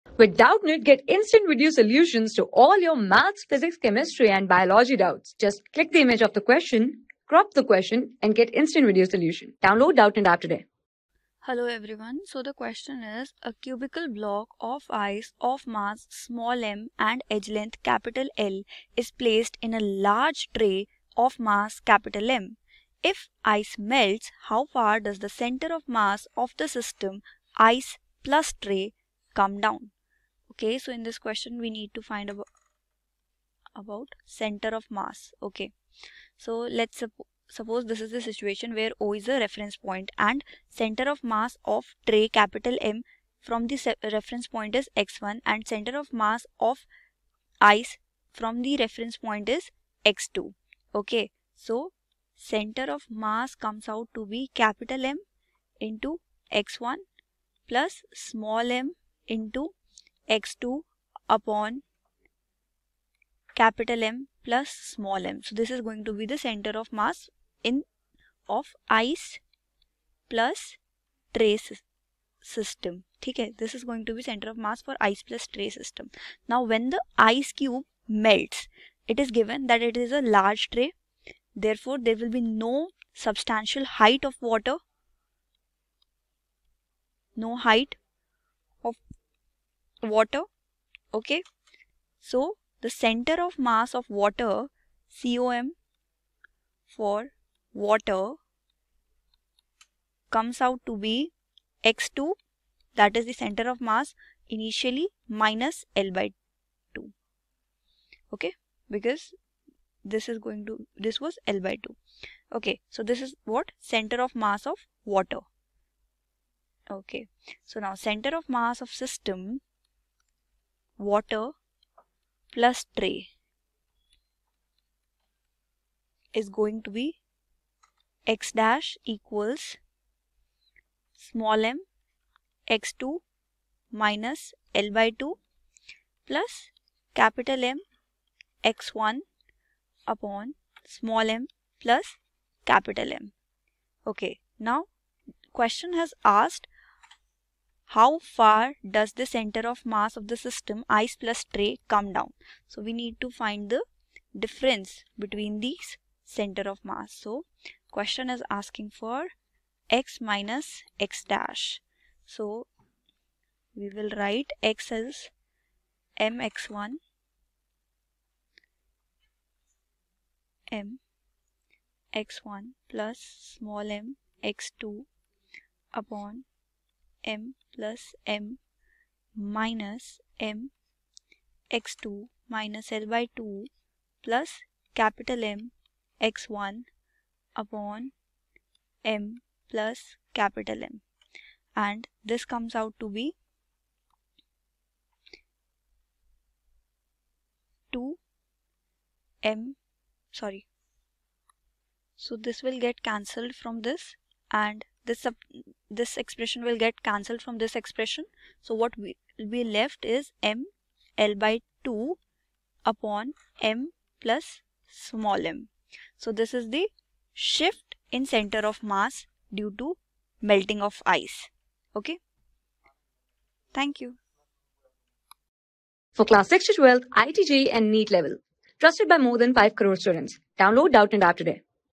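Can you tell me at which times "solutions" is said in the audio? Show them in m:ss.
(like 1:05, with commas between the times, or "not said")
0:01, 0:09.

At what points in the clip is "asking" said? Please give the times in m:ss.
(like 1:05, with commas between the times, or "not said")
2:38.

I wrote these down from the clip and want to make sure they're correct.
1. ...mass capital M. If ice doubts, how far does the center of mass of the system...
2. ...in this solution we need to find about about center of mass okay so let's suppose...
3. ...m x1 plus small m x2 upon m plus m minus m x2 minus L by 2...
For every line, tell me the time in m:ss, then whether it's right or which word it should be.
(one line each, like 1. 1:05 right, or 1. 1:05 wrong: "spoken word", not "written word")
1. 0:21 wrong: "melts", not "doubts"
2. 0:30 wrong: "question", not "solution"
3. 2:50 right.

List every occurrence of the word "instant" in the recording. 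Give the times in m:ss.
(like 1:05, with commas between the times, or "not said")
0:01, 0:08.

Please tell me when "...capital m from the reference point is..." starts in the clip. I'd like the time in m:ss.
0:42.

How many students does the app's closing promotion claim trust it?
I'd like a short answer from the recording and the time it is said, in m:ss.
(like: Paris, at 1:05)
More than 5 crore, at 3:49.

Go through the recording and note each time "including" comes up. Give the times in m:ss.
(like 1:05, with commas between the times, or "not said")
not said.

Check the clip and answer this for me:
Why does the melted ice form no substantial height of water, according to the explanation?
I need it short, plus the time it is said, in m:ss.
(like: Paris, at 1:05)
It is a large tray, at 1:19.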